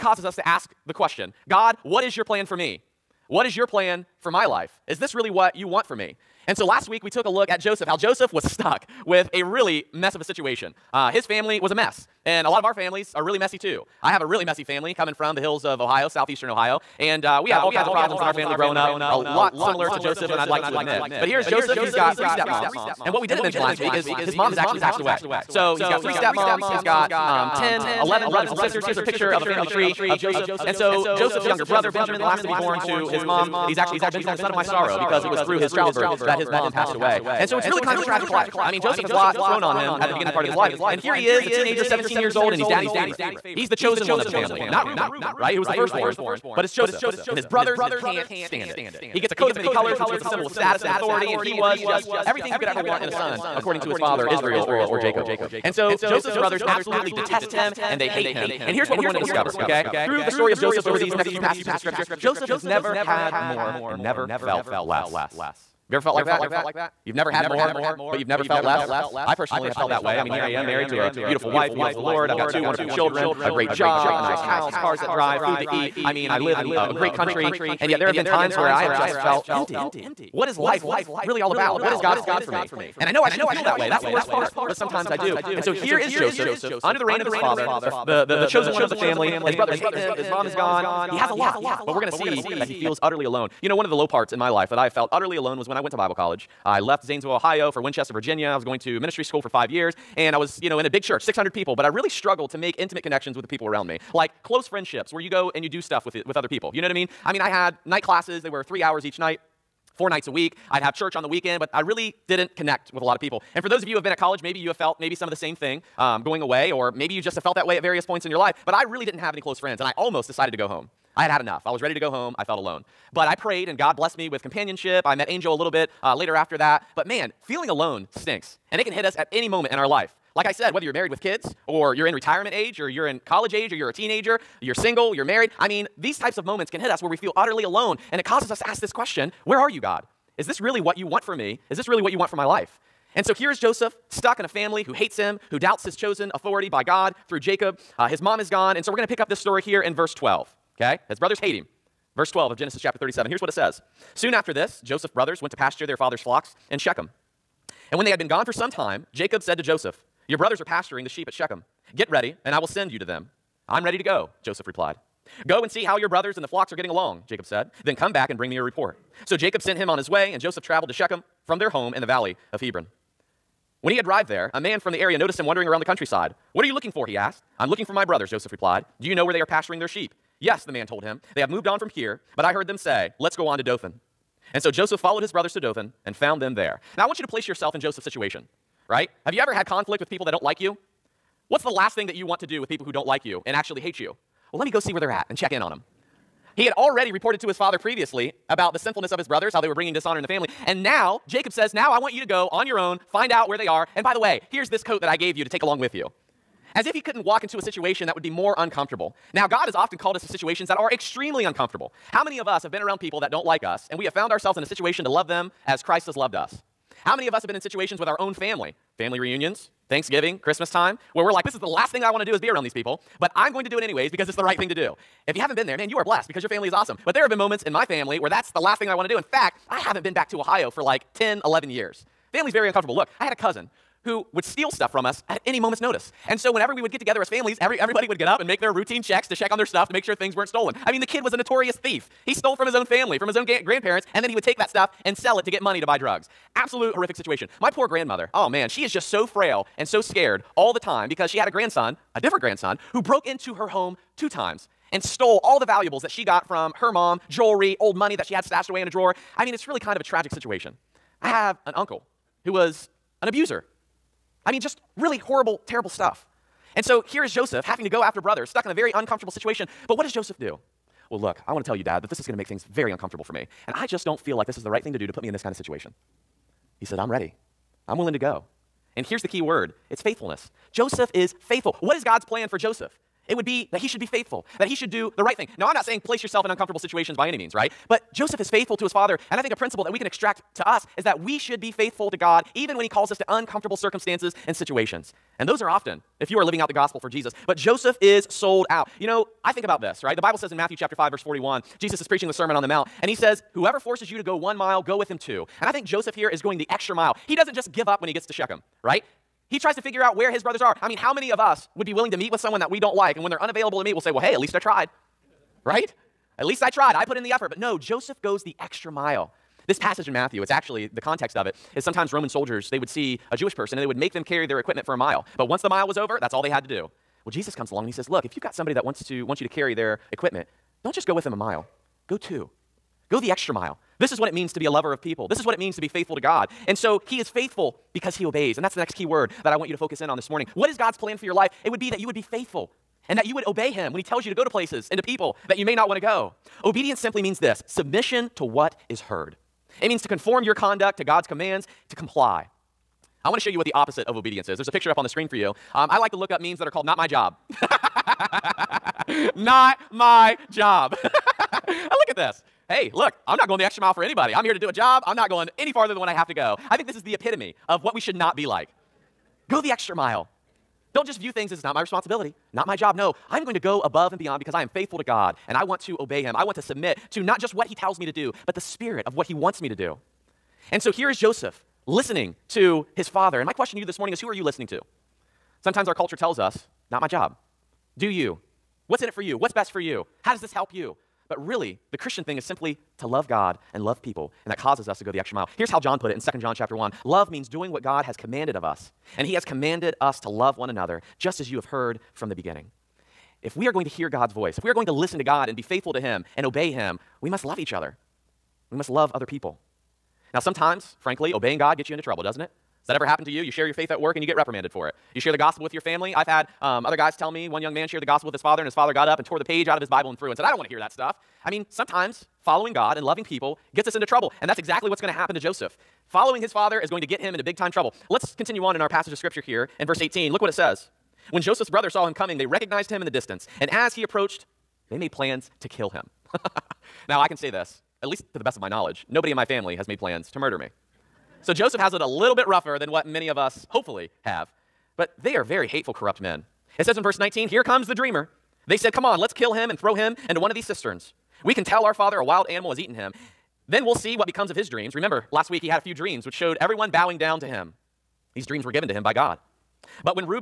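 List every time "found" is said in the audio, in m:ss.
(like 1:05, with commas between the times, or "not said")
3:06, 3:34.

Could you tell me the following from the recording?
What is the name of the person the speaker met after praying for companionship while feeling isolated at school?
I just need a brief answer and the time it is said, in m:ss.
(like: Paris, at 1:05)
Angel, at 2:05.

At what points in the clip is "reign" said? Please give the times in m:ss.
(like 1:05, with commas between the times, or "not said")
1:27.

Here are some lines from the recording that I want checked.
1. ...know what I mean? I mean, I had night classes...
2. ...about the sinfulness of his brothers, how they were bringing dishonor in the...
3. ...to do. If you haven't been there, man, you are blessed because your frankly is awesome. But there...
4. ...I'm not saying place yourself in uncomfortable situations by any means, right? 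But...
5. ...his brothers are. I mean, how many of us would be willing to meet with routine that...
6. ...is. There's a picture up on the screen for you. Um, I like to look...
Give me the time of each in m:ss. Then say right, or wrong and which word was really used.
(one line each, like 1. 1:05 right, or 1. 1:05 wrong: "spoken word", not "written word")
1. 1:46 right
2. 3:18 right
3. 3:44 wrong: "family", not "frankly"
4. 4:45 right
5. 5:10 wrong: "someone", not "routine"
6. 5:54 right.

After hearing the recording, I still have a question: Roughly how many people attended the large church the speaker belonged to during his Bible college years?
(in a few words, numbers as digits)
600.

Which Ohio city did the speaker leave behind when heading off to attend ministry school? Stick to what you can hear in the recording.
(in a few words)
Zanesville.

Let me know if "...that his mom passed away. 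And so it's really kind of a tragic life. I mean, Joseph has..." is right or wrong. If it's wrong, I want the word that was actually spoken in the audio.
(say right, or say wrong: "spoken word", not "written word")
right.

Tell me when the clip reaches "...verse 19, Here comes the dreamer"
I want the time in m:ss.
7:27.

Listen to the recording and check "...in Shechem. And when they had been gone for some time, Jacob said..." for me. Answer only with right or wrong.
right.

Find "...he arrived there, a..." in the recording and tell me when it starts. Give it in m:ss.
2:53.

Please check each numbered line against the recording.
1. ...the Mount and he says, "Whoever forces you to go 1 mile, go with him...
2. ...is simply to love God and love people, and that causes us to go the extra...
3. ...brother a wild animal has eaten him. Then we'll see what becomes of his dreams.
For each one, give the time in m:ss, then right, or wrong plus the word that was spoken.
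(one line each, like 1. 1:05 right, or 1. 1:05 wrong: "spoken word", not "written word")
1. 5:02 right
2. 6:32 right
3. 7:31 wrong: "father", not "brother".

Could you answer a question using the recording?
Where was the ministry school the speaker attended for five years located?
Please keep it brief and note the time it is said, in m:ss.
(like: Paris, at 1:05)
Winchester, Virginia, at 1:37.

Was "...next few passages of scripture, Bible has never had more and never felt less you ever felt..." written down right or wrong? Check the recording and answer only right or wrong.
wrong.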